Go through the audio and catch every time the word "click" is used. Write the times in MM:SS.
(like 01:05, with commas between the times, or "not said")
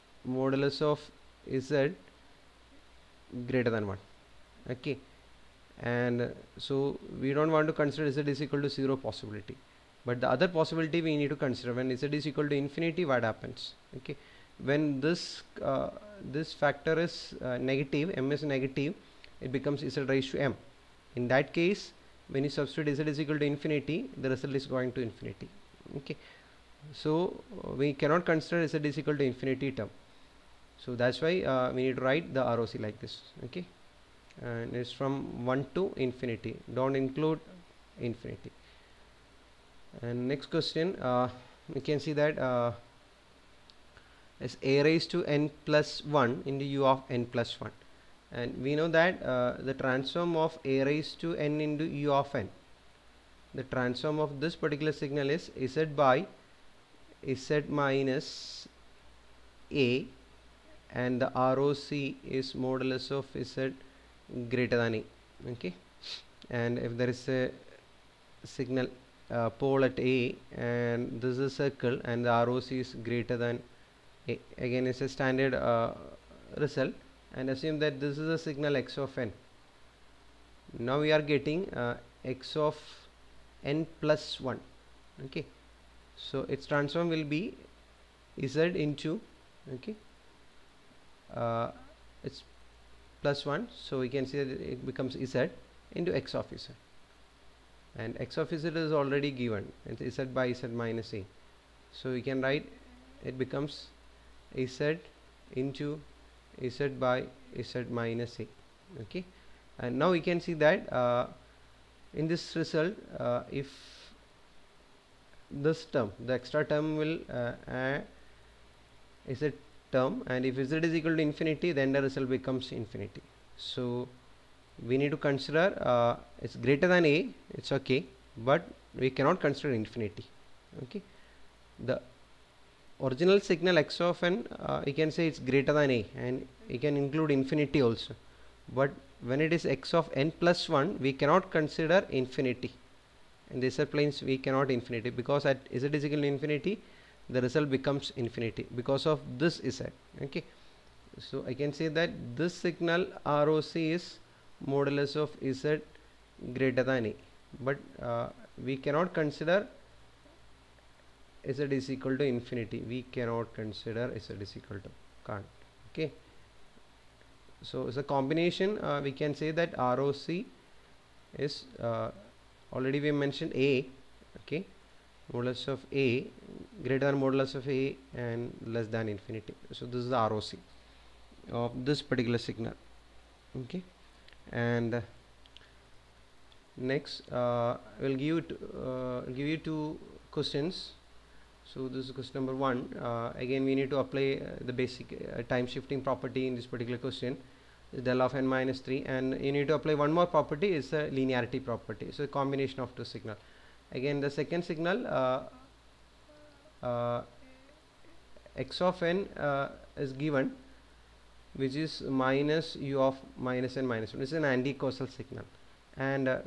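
not said.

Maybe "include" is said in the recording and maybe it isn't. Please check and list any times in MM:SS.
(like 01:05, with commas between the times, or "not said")
00:36, 02:16.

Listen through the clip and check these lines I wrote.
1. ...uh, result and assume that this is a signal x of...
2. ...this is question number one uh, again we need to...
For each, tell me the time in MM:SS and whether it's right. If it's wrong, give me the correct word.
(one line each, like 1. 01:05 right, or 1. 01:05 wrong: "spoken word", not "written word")
1. 01:15 right
2. 03:11 right.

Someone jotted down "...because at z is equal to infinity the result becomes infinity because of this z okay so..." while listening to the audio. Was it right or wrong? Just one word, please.
right.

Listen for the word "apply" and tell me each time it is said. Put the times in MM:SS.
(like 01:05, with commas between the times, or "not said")
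03:14, 03:19.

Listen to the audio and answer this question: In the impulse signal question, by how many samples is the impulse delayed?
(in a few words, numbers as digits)
3.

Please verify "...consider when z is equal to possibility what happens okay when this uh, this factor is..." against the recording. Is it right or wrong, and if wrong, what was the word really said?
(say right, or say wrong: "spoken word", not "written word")
wrong: "infinity", not "possibility".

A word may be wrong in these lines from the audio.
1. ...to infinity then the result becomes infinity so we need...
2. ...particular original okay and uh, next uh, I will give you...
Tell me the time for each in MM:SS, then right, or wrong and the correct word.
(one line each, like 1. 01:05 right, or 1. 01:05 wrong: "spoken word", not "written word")
1. 02:01 right
2. 03:02 wrong: "signal", not "original".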